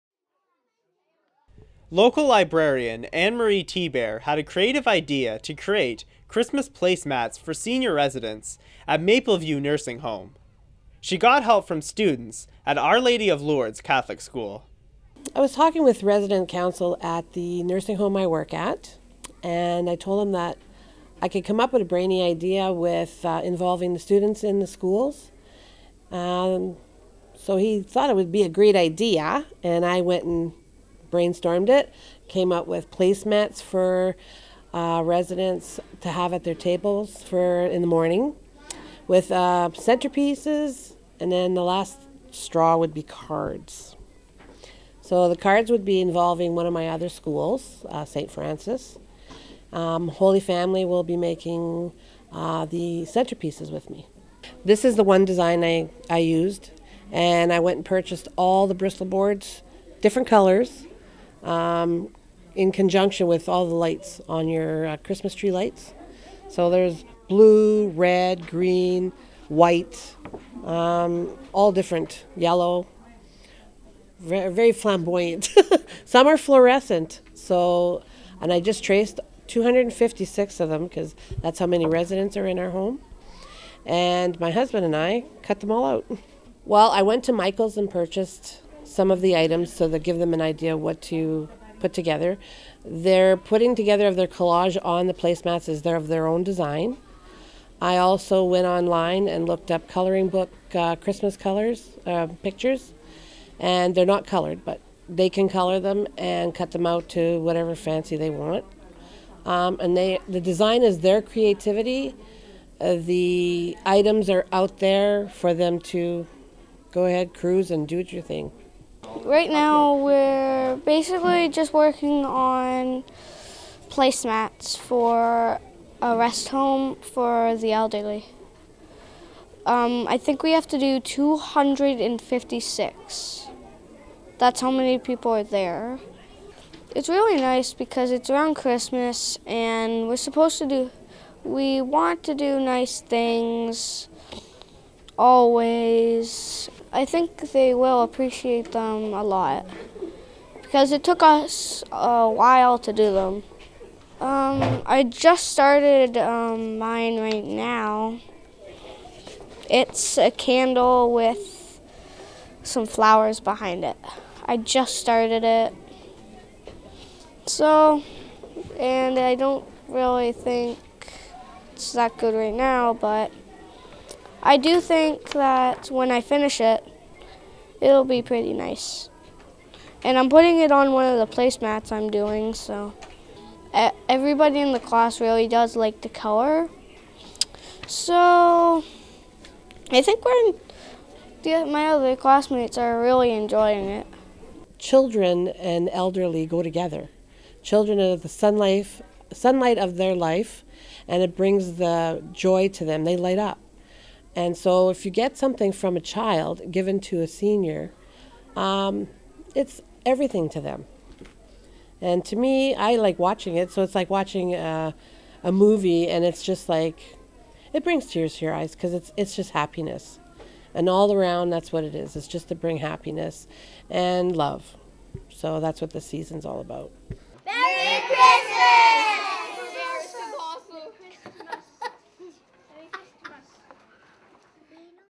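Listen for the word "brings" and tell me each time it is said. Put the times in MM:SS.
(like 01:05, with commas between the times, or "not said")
03:21, 03:37, 03:42.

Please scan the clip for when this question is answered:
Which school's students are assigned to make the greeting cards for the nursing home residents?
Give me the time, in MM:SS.
00:48.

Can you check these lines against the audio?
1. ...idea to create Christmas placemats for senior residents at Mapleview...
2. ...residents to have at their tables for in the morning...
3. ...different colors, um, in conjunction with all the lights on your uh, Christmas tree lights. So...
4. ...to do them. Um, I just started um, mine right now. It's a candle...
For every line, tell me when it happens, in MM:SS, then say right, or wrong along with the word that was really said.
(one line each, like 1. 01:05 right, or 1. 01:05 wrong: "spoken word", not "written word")
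1. 00:04 right
2. 00:35 right
3. 01:00 right
4. 02:32 right.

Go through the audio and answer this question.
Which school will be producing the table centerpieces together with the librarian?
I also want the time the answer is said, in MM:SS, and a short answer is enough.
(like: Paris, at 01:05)
Holy Family, at 00:50.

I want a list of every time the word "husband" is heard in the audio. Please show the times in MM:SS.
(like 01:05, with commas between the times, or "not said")
01:24.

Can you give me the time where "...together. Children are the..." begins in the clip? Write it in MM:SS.
03:16.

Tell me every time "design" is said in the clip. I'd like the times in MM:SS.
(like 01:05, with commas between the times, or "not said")
00:55, 01:36, 01:50.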